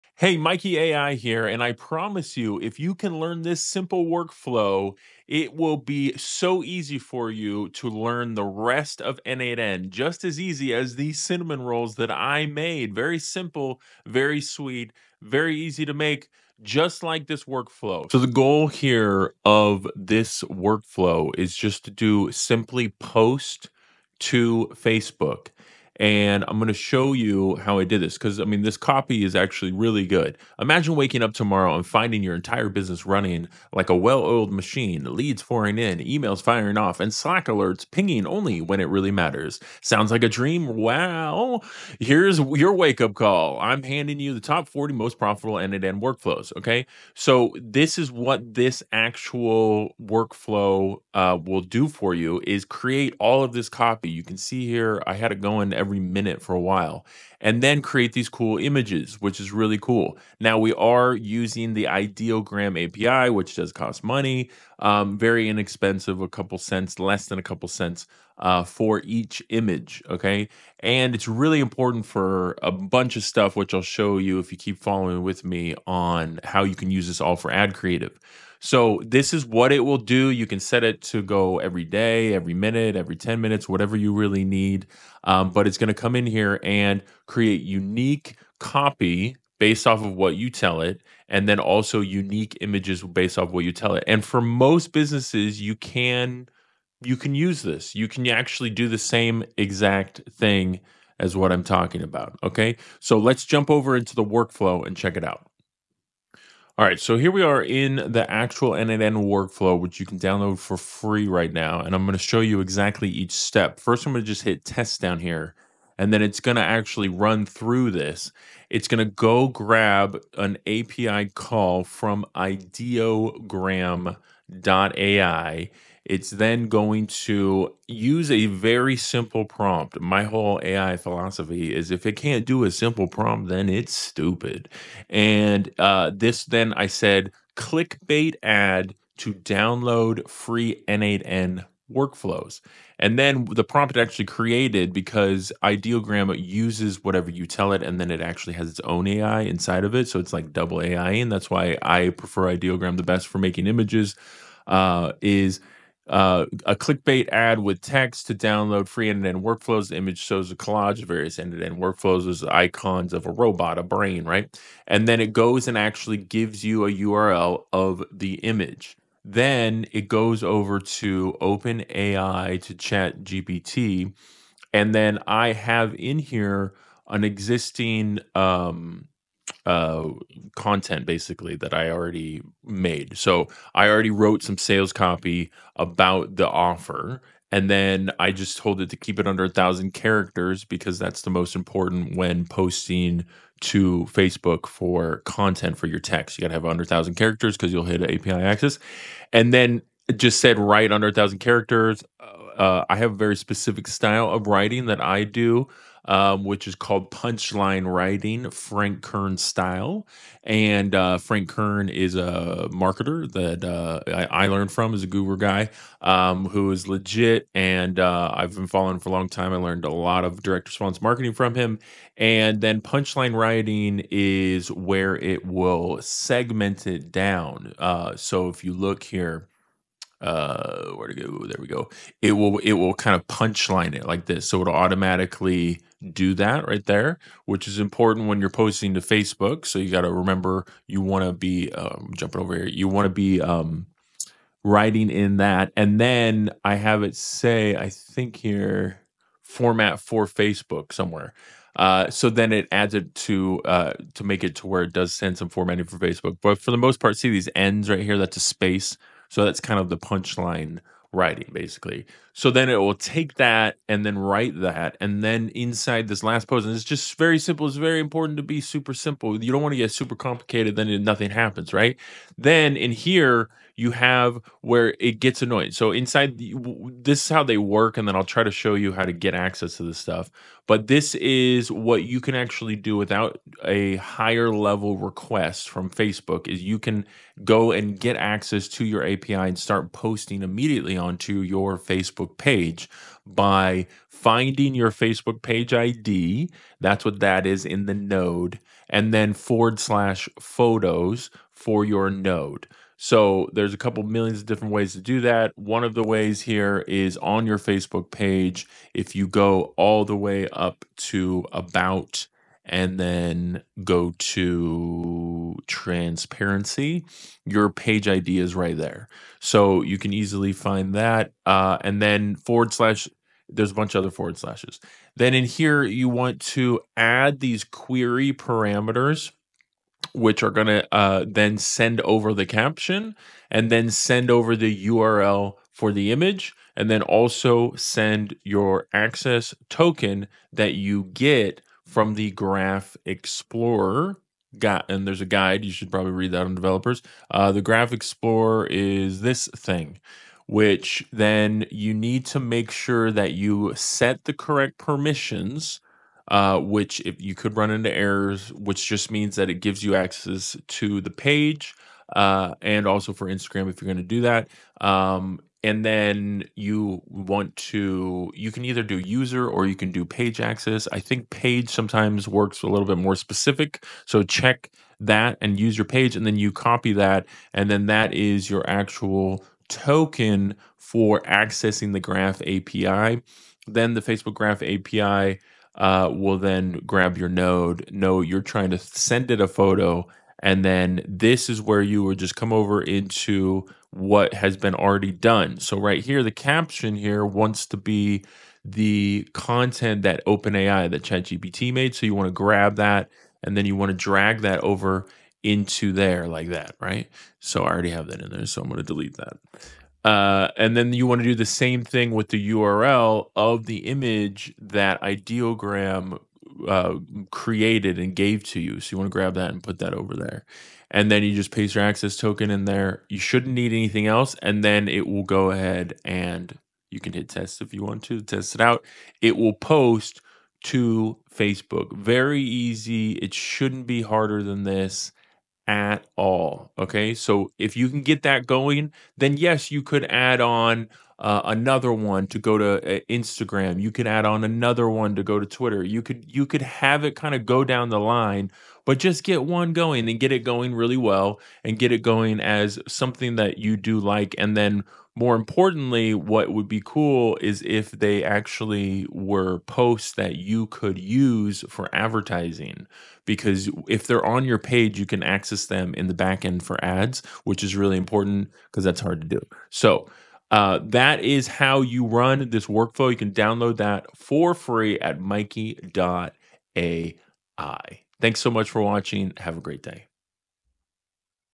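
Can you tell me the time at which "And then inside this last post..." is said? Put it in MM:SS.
04:25.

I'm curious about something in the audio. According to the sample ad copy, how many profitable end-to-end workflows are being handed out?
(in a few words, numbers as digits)
40.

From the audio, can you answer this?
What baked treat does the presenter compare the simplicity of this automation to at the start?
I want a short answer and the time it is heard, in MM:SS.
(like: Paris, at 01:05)
Cinnamon rolls, at 00:11.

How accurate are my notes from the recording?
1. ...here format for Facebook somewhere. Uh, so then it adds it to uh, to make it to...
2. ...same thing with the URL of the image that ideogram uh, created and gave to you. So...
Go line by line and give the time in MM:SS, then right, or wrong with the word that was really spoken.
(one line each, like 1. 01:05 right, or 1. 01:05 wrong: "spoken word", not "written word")
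1. 04:08 right
2. 06:51 right.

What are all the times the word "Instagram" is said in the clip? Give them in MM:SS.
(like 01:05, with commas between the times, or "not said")
06:03, 07:23.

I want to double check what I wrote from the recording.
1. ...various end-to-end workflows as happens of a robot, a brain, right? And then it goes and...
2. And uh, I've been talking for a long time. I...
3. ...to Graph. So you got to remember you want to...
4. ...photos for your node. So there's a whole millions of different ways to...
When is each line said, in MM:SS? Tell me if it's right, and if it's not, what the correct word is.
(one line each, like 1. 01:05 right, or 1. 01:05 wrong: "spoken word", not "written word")
1. 02:41 wrong: "icons", not "happens"
2. 03:37 wrong: "following", not "talking"
3. 03:58 wrong: "Facebook", not "Graph"
4. 05:00 wrong: "couple", not "whole".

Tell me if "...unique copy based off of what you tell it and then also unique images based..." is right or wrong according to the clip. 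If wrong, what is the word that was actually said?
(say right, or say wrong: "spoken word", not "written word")
right.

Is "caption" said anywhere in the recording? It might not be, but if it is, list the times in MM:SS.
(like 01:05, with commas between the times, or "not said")
05:32, 06:36.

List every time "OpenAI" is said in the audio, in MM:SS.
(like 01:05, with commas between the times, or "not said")
02:51, 06:40.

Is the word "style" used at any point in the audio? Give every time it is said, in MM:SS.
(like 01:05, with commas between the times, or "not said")
03:23, 03:29.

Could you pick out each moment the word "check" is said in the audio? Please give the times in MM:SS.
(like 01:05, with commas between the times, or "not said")
01:44, 06:14.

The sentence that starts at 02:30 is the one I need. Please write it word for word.
So it's like double AI, and that's why I prefer Ideogram the best for making images.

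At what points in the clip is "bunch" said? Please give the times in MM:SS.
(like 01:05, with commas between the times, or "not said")
01:12, 05:23.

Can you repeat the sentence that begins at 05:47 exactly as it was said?
Uh, the Graph Explorer is this thing, which then you need to make sure that you set the correct permissions.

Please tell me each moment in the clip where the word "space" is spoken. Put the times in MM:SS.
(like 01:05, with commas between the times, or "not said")
04:18.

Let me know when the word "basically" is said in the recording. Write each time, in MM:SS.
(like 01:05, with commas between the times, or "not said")
03:01, 04:21.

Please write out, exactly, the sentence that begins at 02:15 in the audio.
And uh, this, then I said, clickbait ad to download free N8N workflows.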